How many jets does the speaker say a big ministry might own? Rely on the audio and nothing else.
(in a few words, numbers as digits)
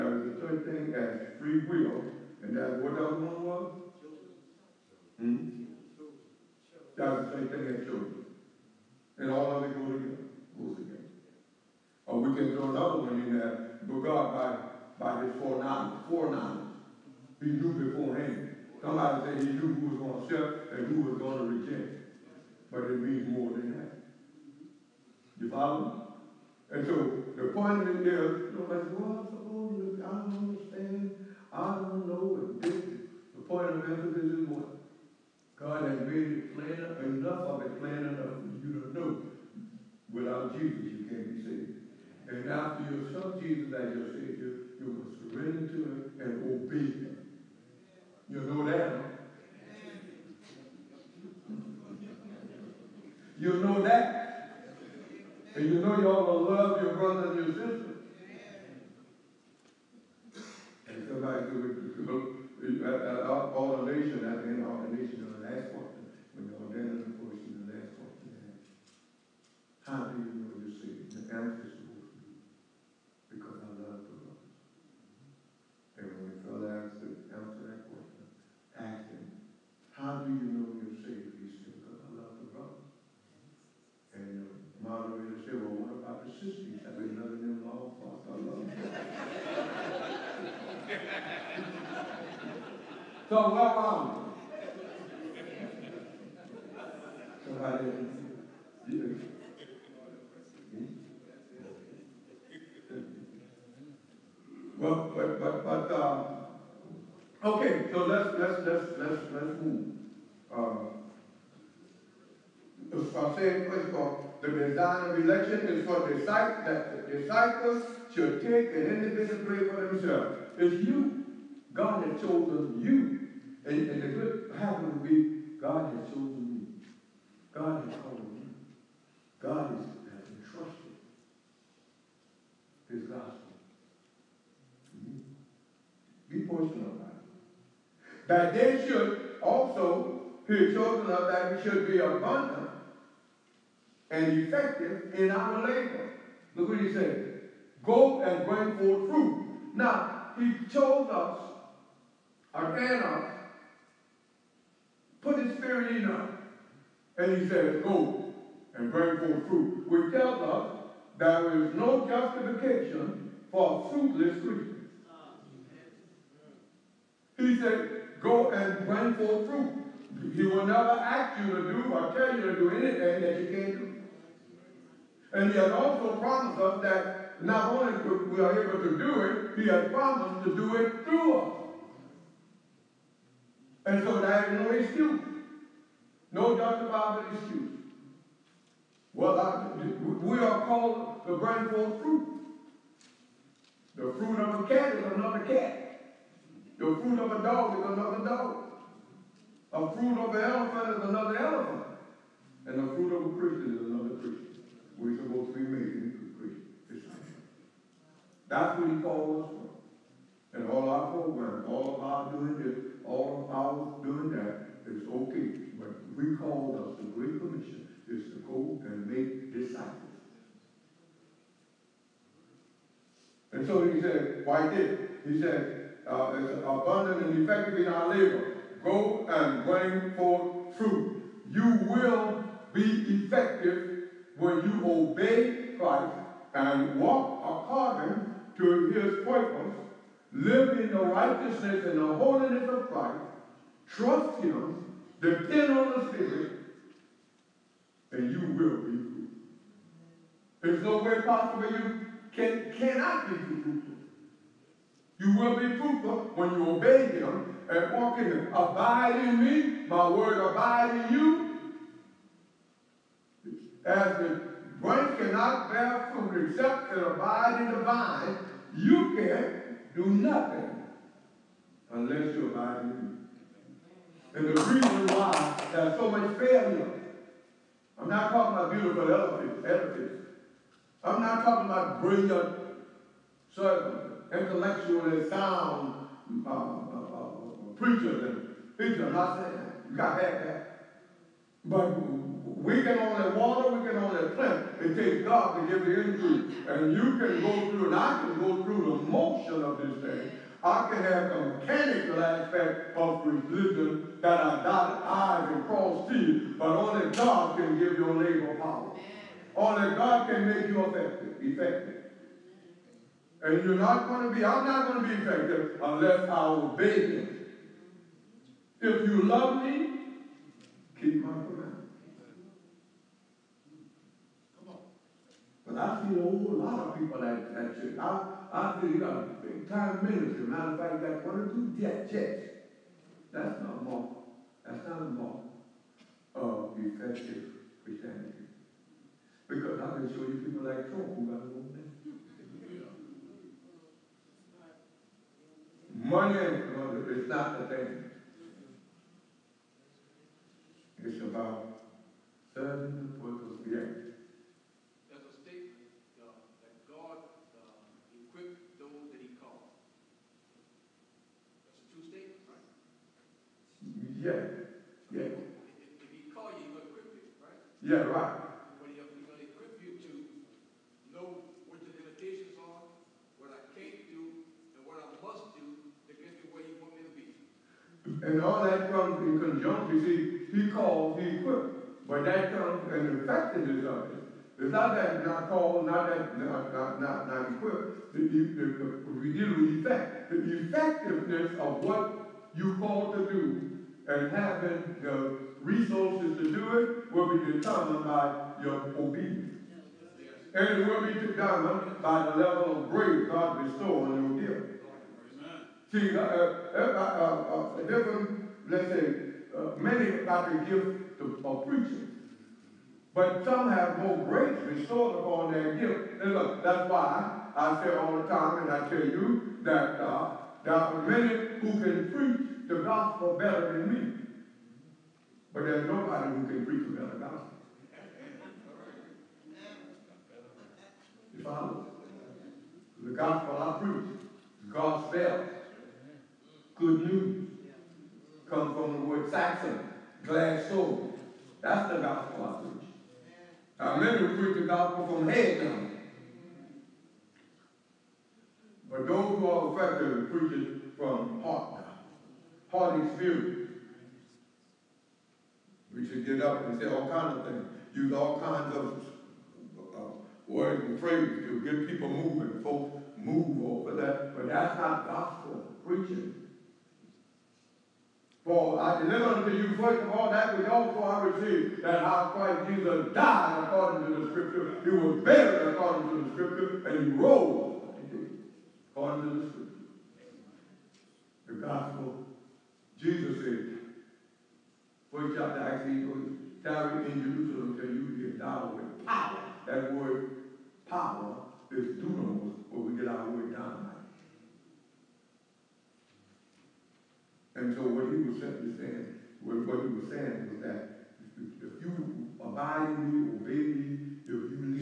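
one or two.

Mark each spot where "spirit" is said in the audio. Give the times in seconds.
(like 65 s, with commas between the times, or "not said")
155 s, 246 s, 453 s.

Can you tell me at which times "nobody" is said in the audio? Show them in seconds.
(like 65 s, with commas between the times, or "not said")
28 s, 425 s.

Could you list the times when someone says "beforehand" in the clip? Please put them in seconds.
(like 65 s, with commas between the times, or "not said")
17 s.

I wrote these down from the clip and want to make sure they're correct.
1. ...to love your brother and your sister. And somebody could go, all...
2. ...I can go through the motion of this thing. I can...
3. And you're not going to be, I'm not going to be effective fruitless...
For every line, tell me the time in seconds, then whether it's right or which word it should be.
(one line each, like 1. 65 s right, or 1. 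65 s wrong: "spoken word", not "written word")
1. 56 s right
2. 297 s right
3. 313 s wrong: "unless", not "fruitless".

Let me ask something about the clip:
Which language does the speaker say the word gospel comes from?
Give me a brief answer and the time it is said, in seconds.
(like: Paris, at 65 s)
Saxon, at 439 s.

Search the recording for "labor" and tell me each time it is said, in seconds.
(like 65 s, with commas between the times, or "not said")
145 s, 228 s, 308 s.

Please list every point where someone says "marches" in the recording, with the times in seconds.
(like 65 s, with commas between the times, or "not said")
not said.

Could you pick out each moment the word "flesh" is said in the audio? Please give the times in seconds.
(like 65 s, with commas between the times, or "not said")
not said.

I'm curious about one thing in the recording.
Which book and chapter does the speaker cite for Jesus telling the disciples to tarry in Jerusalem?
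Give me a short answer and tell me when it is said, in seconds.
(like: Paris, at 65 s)
Acts chapter 1, at 485 s.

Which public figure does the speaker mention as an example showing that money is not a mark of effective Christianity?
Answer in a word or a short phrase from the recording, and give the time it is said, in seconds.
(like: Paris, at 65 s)
Trump, at 340 s.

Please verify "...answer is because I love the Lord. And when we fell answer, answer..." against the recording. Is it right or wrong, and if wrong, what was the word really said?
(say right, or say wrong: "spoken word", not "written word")
right.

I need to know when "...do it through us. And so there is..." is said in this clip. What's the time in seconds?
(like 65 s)
180 s.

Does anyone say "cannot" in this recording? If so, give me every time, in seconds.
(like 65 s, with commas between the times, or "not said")
252 s, 265 s.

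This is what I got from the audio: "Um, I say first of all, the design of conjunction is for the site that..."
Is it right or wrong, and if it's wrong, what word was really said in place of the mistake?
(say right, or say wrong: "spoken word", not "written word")
wrong: "election", not "conjunction".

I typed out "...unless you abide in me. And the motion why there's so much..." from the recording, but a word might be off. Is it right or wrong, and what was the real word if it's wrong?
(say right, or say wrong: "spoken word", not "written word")
wrong: "reason", not "motion".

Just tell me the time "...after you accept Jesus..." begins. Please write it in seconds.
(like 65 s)
42 s.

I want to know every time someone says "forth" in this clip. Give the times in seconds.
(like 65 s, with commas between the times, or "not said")
148 s, 159 s, 169 s, 191 s, 230 s.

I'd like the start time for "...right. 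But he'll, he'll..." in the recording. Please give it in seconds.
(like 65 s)
368 s.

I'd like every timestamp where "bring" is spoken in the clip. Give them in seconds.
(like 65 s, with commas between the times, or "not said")
148 s, 158 s, 168 s, 191 s, 229 s.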